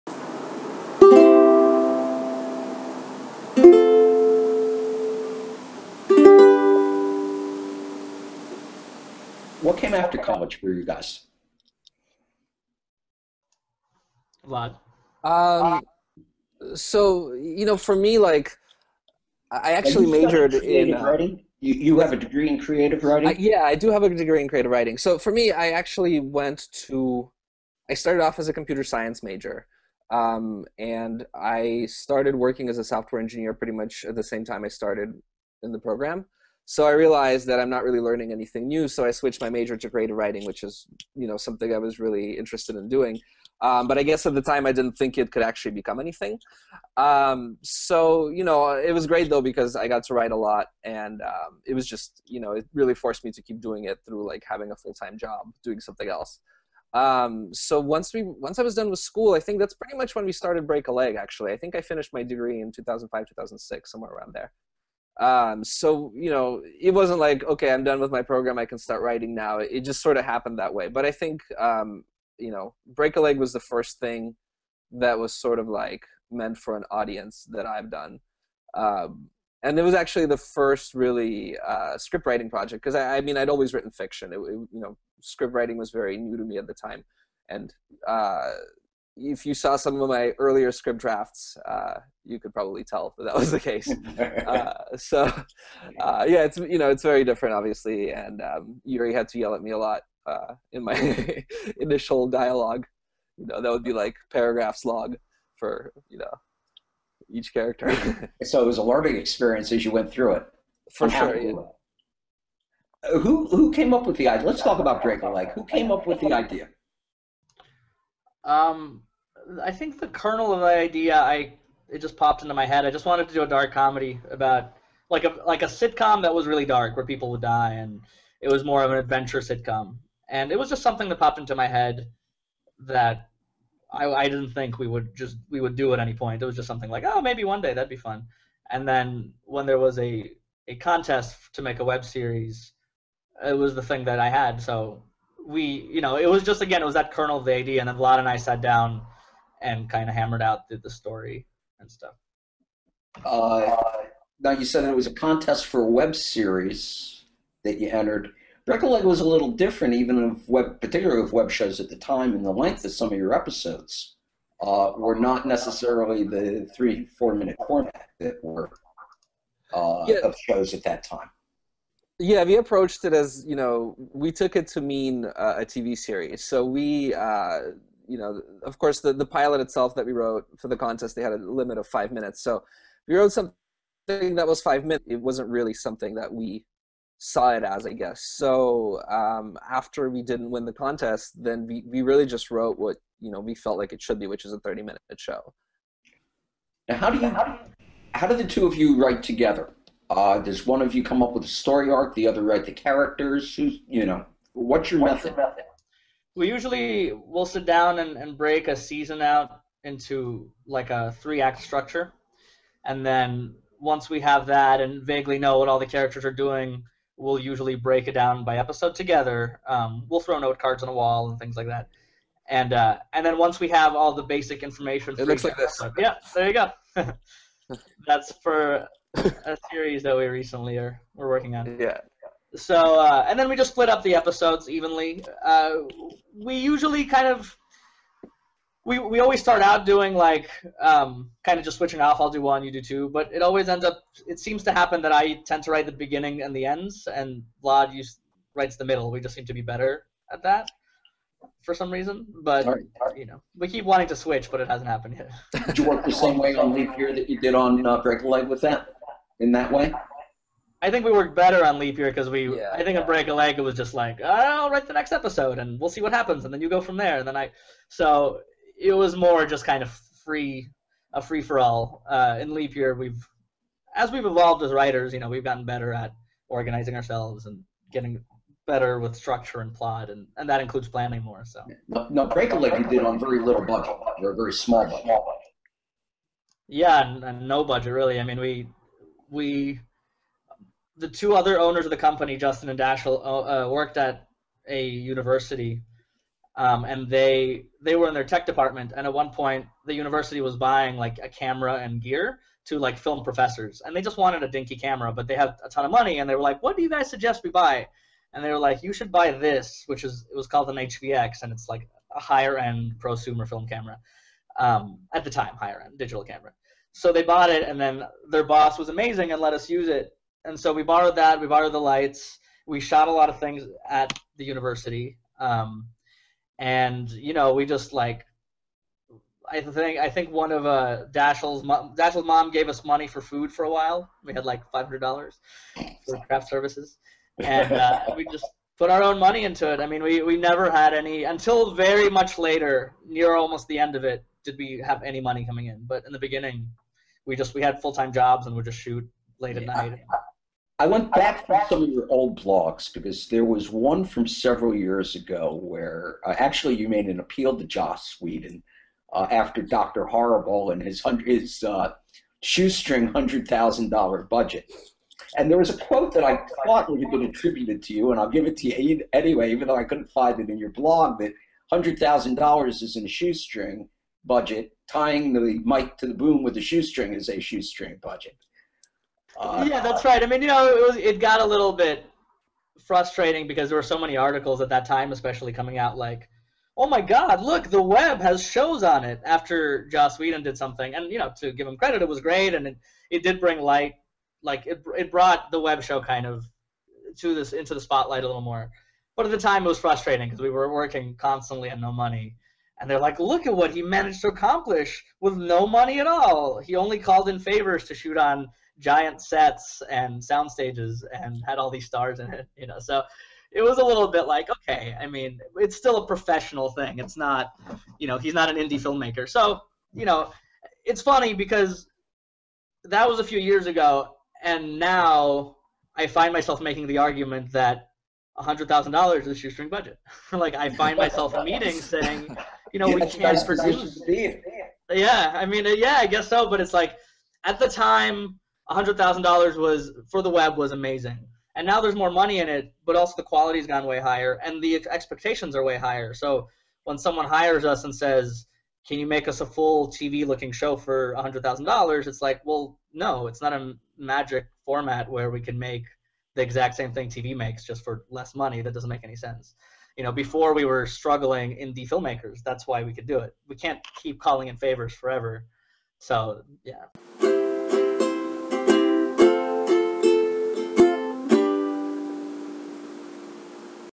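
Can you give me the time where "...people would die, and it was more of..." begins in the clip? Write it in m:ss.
2:07.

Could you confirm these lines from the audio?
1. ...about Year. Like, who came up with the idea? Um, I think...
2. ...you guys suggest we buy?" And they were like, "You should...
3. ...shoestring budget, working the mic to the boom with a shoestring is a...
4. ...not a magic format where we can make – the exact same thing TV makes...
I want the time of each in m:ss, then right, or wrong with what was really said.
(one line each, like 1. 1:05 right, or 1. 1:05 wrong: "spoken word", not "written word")
1. 1:54 wrong: "Draco", not "Year"
2. 5:06 right
3. 6:13 wrong: "tying", not "working"
4. 7:33 right.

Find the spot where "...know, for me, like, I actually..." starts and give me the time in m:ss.
0:17.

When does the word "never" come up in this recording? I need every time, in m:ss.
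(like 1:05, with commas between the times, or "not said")
5:40.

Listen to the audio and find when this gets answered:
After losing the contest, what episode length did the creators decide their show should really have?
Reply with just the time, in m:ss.
3:14.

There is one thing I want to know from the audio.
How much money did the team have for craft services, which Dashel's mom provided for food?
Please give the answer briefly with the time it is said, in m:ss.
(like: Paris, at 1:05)
$500, at 5:34.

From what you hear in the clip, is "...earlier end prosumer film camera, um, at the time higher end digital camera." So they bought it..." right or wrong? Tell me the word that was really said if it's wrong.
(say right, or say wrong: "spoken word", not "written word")
wrong: "higher", not "earlier".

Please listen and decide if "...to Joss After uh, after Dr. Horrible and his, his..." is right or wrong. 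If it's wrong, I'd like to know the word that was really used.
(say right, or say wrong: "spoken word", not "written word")
wrong: "Whedon", not "After".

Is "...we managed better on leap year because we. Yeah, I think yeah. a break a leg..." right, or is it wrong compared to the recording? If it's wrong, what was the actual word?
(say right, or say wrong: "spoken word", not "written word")
wrong: "worked", not "managed".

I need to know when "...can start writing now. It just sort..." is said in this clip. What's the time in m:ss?
1:08.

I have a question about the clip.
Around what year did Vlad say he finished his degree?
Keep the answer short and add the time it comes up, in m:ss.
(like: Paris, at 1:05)
2005, at 1:02.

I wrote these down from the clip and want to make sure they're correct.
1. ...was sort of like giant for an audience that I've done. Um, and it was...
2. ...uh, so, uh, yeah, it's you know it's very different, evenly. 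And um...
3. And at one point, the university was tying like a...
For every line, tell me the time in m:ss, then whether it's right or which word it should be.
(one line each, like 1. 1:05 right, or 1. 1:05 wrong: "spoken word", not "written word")
1. 1:15 wrong: "meant", not "giant"
2. 1:34 wrong: "obviously", not "evenly"
3. 4:58 wrong: "buying", not "tying".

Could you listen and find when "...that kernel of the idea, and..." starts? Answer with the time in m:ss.
2:26.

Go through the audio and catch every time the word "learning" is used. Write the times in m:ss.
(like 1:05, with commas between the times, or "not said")
0:37, 1:48.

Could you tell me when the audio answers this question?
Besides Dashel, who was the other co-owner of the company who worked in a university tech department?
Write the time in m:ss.
4:52.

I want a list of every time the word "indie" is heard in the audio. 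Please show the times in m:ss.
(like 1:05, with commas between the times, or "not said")
6:58, 7:41.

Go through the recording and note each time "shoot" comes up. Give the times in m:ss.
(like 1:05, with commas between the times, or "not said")
5:48, 6:47.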